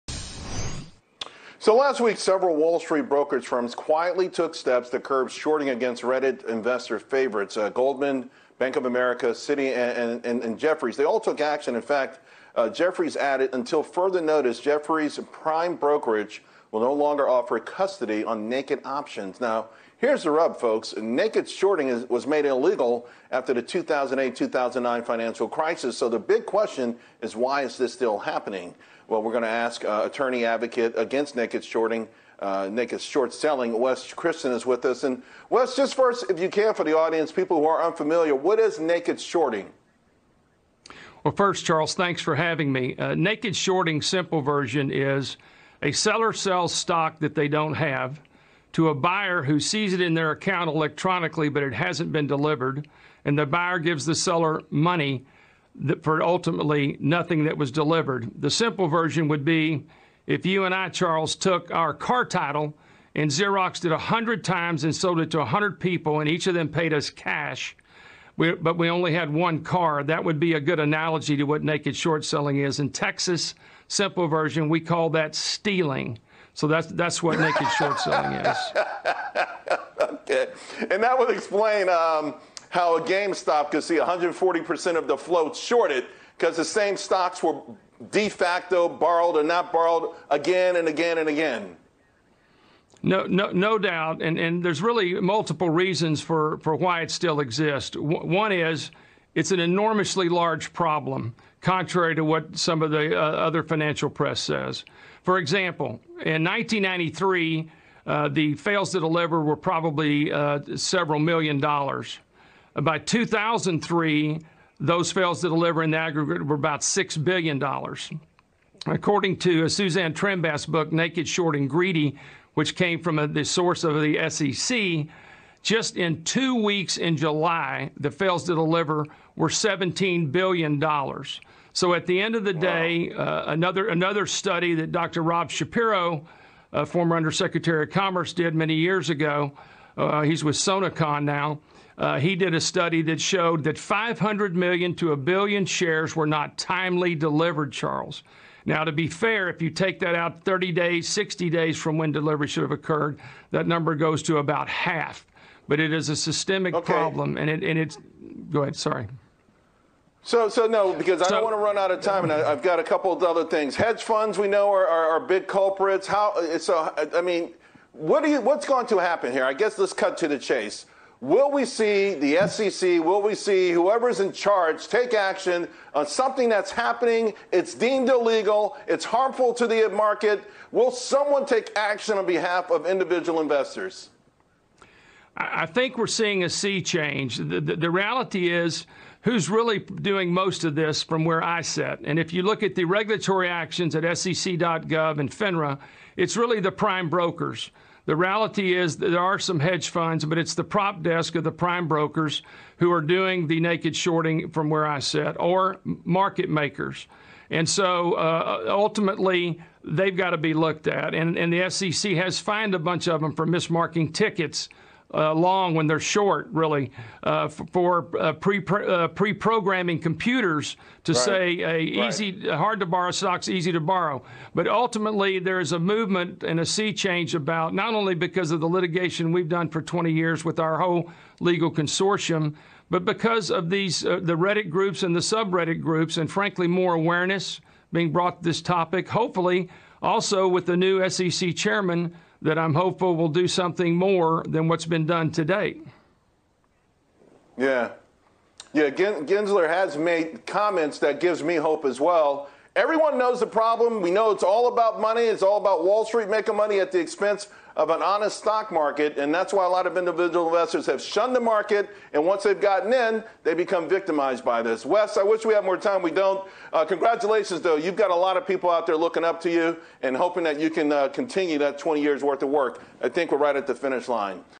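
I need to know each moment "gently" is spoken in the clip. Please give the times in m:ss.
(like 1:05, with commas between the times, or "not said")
not said.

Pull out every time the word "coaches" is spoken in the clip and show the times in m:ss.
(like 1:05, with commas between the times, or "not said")
not said.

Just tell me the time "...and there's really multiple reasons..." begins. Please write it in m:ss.
1:34.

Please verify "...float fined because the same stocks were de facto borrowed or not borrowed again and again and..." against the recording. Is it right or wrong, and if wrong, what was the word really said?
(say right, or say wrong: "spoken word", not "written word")
wrong: "shorted", not "fined".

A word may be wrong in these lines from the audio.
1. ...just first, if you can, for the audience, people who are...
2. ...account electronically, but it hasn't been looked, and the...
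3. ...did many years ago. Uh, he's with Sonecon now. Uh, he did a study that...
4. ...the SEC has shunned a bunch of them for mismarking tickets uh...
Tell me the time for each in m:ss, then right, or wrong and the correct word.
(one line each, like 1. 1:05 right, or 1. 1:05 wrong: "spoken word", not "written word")
1. 0:35 right
2. 0:50 wrong: "delivered", not "looked"
3. 2:18 right
4. 3:31 wrong: "fined", not "shunned".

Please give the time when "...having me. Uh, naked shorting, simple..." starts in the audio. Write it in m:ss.
0:42.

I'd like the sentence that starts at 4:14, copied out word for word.
We know it's all about money.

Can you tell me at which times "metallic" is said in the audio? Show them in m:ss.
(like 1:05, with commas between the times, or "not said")
not said.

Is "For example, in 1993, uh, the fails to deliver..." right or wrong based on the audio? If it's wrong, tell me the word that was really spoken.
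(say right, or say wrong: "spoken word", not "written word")
right.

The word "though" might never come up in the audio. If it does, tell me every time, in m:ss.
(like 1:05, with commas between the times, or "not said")
4:27.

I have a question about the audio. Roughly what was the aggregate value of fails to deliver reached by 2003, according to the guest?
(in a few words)
$6 billion.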